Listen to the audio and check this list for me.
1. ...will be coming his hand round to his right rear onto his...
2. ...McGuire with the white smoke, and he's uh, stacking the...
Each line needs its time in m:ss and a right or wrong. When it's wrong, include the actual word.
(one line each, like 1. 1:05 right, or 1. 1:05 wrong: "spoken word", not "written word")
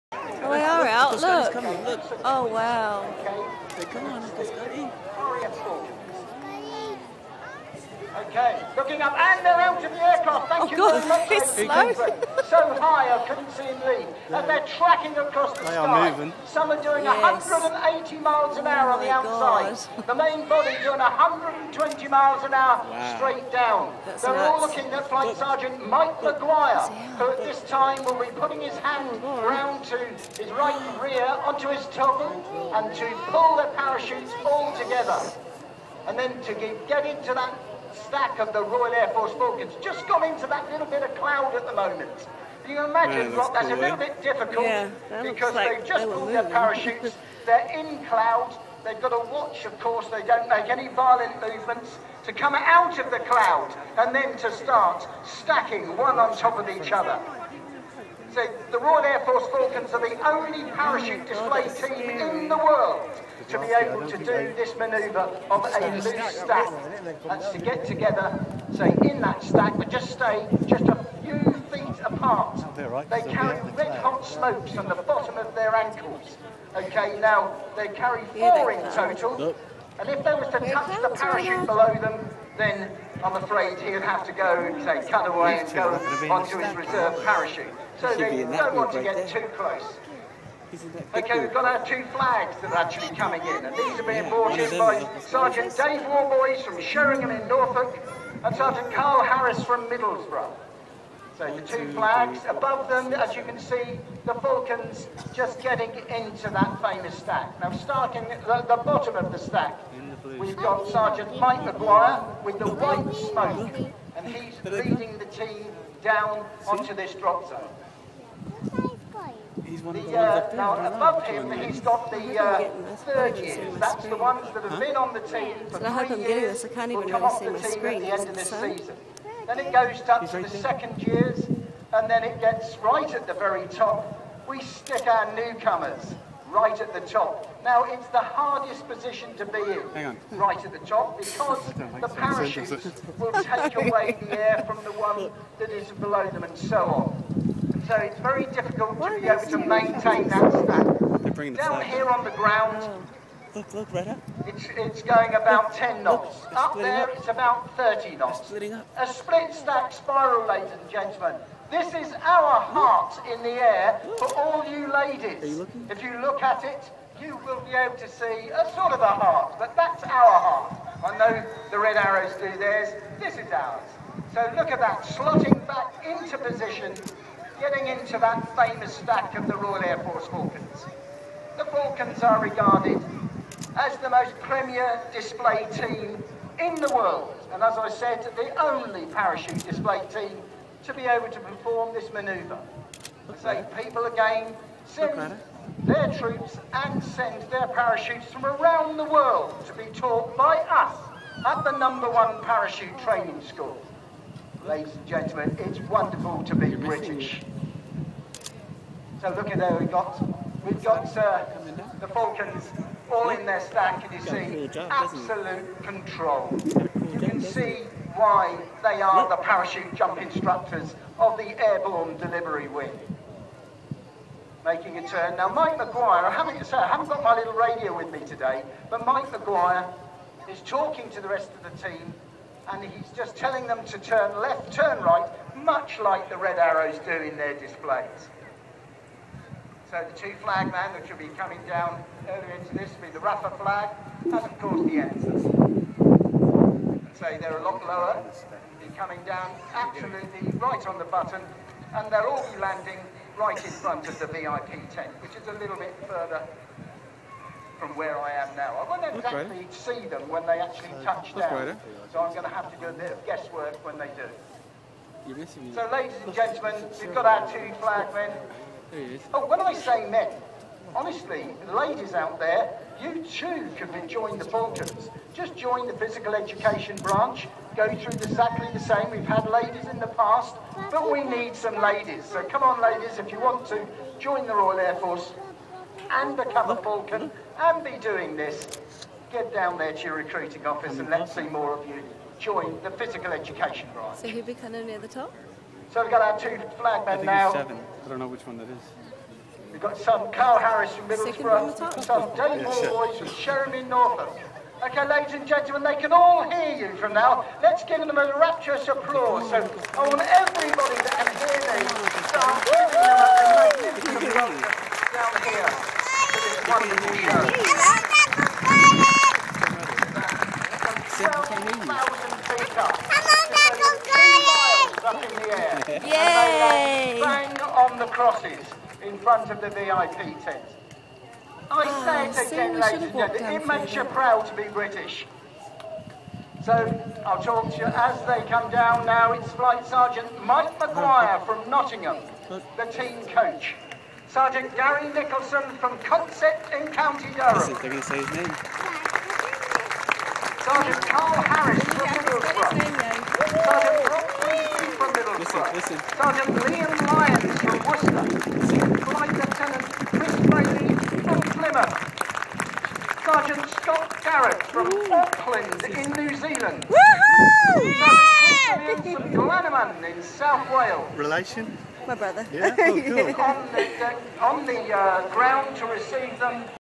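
1. 0:28 wrong: "putting", not "coming"
2. 1:51 wrong: "leading", not "stacking".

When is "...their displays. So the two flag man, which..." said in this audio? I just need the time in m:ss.
3:57.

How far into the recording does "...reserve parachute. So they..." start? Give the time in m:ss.
1:26.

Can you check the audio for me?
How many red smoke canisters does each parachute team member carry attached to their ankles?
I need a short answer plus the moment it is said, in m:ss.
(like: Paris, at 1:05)
4, at 1:18.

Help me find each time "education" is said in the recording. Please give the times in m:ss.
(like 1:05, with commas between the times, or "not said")
4:36, 4:53.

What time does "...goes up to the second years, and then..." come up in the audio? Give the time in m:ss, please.
2:09.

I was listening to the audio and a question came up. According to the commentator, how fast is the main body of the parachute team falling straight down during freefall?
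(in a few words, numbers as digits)
120 miles an hour.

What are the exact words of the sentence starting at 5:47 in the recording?
They're going to say his name.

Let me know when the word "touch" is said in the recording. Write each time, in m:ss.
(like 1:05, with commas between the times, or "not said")
1:20, 4:21.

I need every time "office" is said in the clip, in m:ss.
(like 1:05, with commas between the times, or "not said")
4:50.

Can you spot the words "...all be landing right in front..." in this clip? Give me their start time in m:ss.
4:12.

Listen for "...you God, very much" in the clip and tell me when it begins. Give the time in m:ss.
0:10.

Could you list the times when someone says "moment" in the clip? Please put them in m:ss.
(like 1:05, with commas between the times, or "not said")
0:41.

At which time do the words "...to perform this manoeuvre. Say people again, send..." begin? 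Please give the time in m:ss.
3:11.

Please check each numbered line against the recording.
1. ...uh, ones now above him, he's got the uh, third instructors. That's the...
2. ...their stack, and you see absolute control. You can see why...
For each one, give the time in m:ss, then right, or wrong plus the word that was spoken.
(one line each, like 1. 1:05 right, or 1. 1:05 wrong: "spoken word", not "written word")
1. 2:00 wrong: "years", not "instructors"
2. 3:33 right.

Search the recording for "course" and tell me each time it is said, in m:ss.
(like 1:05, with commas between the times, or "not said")
0:49, 4:04.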